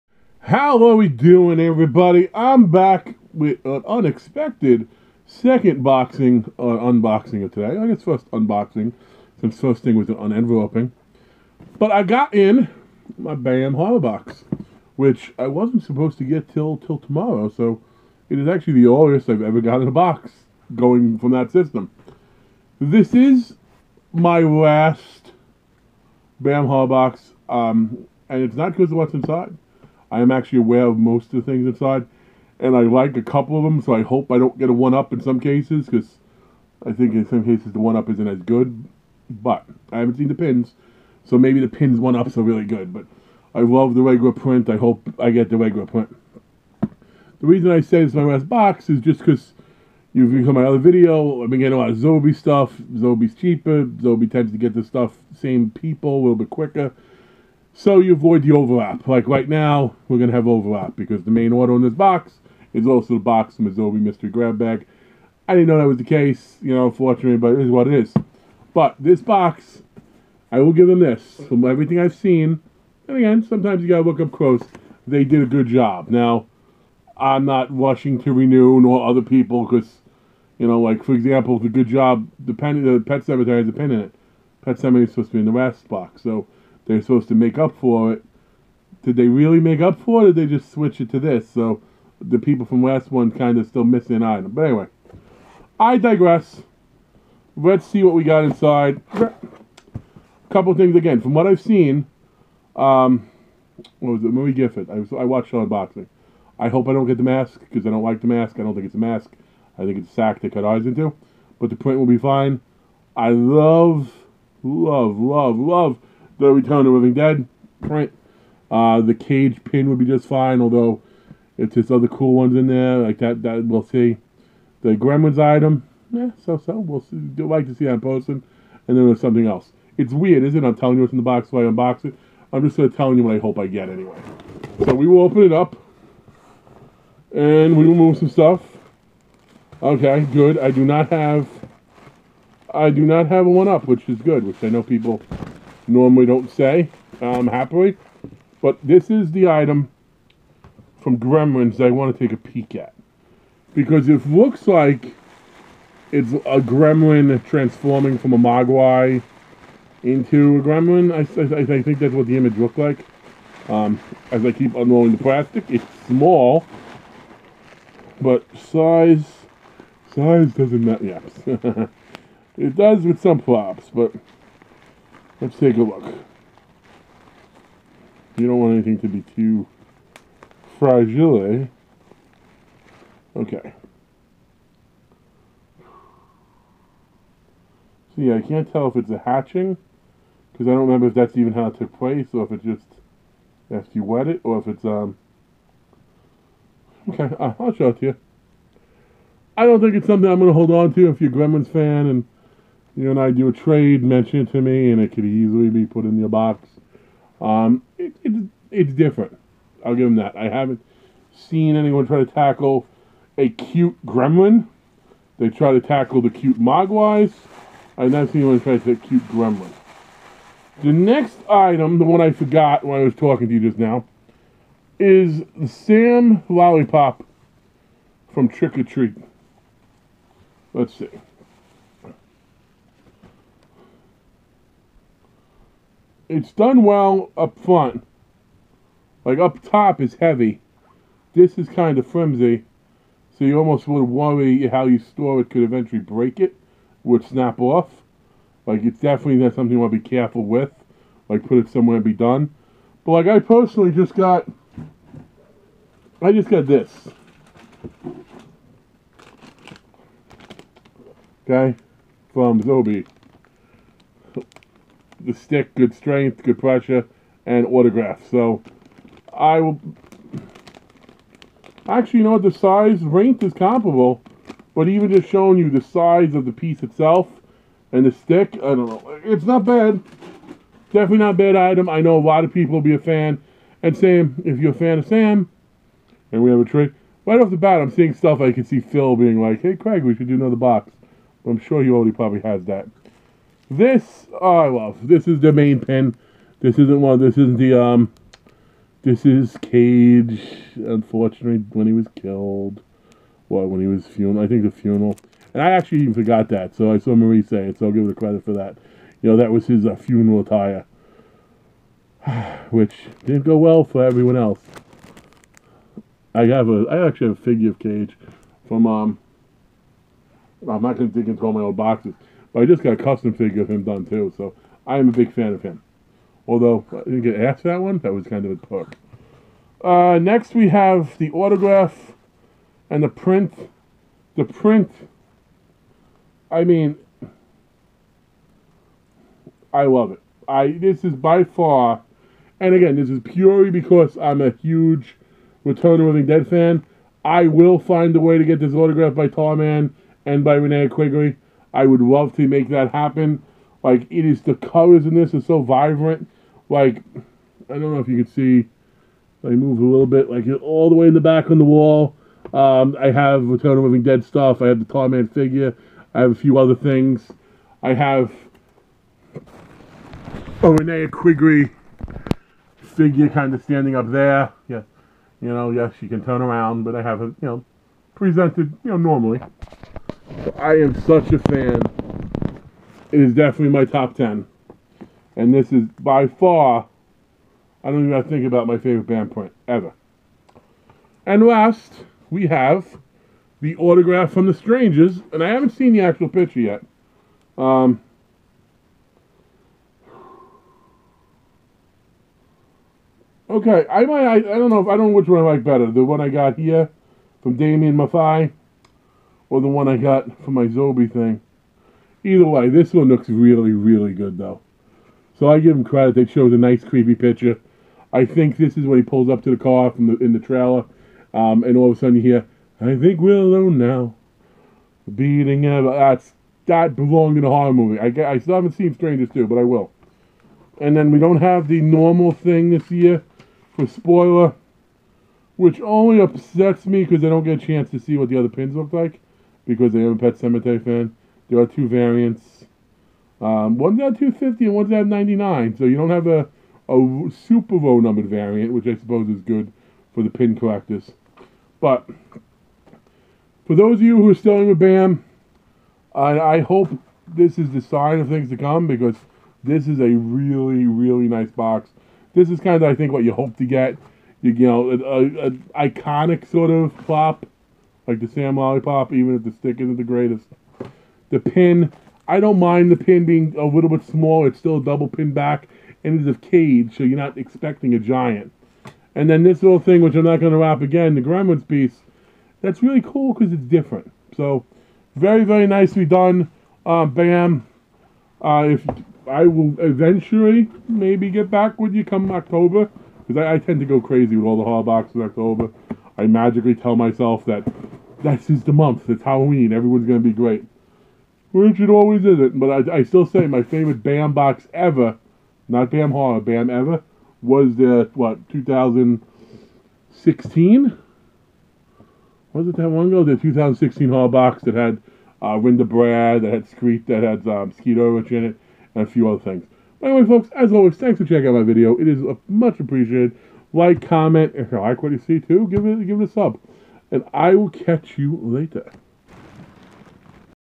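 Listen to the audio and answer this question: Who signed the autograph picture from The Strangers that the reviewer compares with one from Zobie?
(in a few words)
Damian Maffei.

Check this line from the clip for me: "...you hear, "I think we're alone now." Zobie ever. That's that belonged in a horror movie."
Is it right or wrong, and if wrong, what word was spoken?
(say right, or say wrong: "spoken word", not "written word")
wrong: "Beating", not "Zobie".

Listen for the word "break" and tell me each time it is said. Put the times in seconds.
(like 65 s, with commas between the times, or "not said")
245 s.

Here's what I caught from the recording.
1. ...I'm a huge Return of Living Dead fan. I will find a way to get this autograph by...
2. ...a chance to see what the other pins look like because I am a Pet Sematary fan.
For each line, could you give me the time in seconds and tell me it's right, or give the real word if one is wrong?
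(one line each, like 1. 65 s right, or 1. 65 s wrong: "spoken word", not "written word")
1. 344 s right
2. 437 s right.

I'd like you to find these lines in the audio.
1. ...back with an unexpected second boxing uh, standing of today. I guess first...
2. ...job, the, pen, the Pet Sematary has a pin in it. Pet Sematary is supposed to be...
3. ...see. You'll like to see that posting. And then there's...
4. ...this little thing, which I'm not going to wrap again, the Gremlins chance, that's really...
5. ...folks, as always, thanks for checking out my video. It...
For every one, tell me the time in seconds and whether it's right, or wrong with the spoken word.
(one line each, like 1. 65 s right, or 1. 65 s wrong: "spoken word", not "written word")
1. 2 s wrong: "unboxing", not "standing"
2. 81 s right
3. 127 s right
4. 479 s wrong: "piece", not "chance"
5. 520 s right.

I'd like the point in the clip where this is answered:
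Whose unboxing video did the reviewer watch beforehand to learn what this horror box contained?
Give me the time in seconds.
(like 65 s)
104 s.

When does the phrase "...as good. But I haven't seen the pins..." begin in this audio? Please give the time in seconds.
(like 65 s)
38 s.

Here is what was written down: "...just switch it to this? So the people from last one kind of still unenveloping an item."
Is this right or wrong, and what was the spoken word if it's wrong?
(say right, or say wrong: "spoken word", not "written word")
wrong: "missing", not "unenveloping".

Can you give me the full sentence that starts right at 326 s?
Although I didn't get asked that one, that was kind of a perk.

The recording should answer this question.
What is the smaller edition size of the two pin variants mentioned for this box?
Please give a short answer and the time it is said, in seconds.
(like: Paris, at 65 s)
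99, at 445 s.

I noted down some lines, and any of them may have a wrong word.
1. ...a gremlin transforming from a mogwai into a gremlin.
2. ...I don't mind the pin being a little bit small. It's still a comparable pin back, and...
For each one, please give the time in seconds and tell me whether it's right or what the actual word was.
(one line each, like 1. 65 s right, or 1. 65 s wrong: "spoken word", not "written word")
1. 156 s right
2. 472 s wrong: "double", not "comparable".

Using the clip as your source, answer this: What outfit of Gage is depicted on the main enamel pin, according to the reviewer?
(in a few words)
funeral attire.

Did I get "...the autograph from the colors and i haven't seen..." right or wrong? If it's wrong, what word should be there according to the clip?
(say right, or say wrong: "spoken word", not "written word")
wrong: "strangers", not "colors".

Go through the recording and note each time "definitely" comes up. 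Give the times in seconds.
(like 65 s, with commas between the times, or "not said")
248 s, 280 s, 383 s.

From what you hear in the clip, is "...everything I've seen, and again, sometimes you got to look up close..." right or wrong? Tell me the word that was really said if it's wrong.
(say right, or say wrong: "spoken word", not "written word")
right.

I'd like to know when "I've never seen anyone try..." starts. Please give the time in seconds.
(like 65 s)
217 s.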